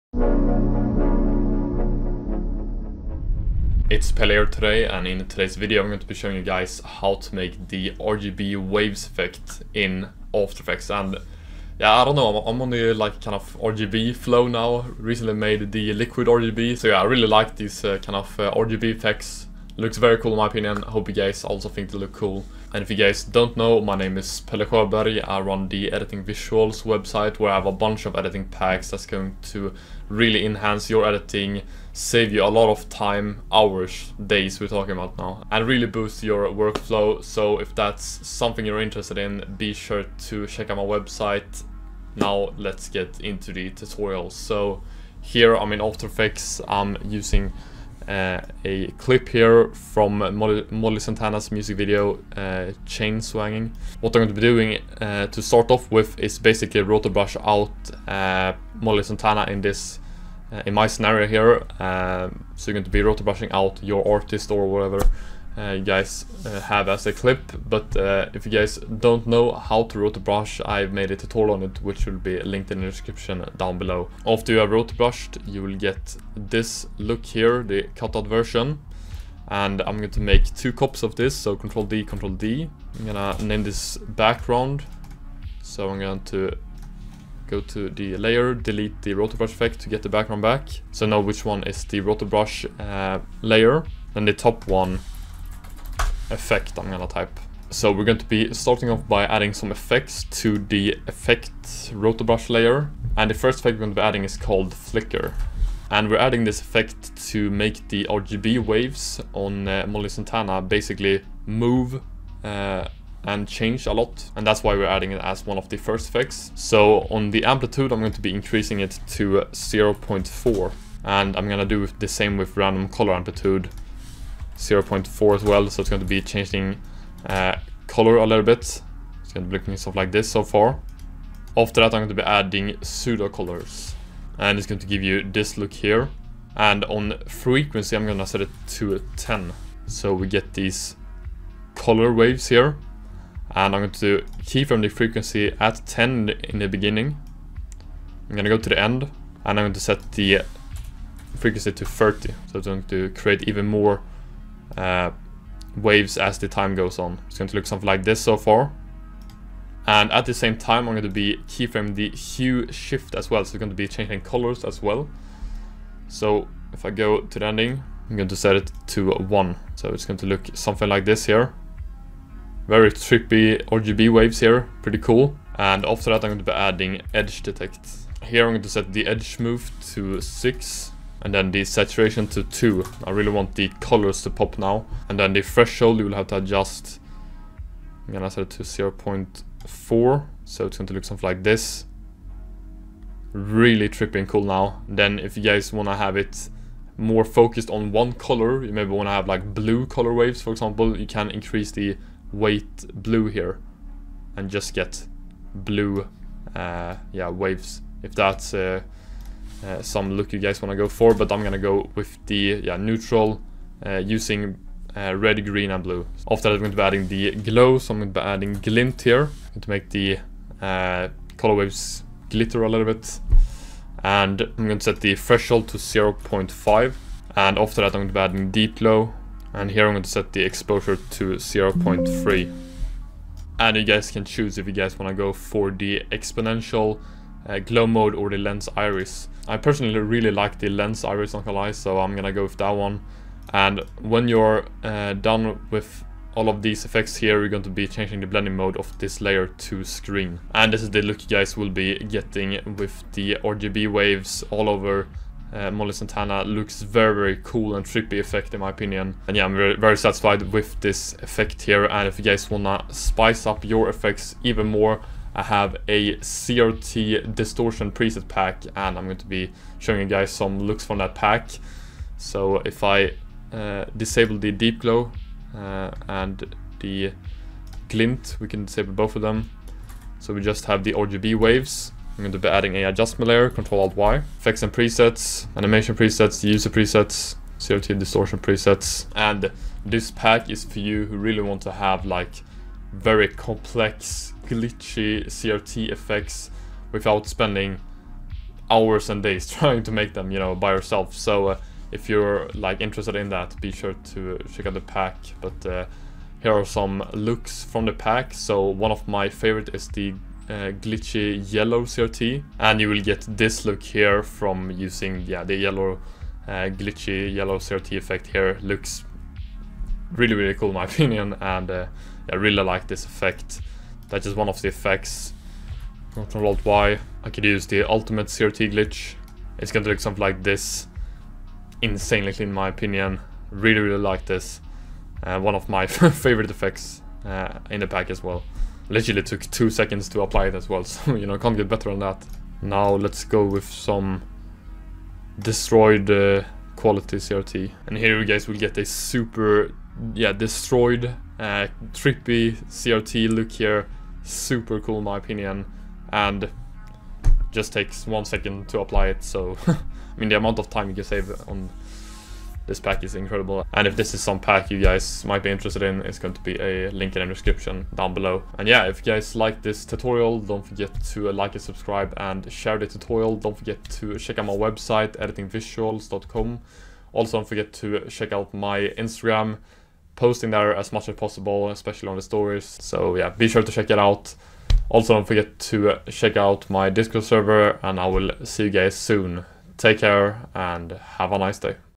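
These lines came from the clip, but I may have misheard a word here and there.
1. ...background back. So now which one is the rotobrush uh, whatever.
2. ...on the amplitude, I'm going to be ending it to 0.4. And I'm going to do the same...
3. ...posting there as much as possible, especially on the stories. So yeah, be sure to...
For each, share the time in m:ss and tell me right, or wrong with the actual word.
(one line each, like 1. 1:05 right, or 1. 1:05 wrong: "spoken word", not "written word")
1. 1:30 wrong: "layer", not "whatever"
2. 1:57 wrong: "increasing", not "ending"
3. 6:20 right.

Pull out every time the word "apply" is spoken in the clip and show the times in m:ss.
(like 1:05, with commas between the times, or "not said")
5:40, 5:58.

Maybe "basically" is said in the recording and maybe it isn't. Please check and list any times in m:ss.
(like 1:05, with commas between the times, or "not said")
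0:56, 1:50.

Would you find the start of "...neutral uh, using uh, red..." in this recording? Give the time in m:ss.
3:32.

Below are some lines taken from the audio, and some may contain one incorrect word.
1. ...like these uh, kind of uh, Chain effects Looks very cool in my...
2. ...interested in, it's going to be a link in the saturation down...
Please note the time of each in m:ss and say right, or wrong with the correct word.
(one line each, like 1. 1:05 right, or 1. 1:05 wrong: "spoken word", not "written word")
1. 0:17 wrong: "RGB", not "Chain"
2. 6:05 wrong: "description", not "saturation".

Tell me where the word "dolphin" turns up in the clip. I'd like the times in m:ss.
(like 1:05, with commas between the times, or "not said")
not said.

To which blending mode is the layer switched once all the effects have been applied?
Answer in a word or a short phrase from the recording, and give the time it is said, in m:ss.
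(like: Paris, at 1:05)
Screen, at 4:09.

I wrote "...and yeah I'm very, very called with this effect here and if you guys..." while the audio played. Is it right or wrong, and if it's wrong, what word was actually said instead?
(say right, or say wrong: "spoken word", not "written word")
wrong: "satisfied", not "called".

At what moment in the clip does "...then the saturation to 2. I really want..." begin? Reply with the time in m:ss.
3:01.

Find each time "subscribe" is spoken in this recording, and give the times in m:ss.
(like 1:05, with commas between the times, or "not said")
6:11.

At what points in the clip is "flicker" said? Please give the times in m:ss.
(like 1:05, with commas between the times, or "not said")
1:44.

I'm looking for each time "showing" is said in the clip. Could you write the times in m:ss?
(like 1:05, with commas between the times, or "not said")
0:06, 4:29.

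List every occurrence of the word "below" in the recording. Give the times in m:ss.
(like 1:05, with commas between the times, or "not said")
1:13, 6:08.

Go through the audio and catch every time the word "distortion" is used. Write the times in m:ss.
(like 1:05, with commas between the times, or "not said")
4:27, 4:47.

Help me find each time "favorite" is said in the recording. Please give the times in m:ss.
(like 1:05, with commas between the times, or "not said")
5:09, 5:35.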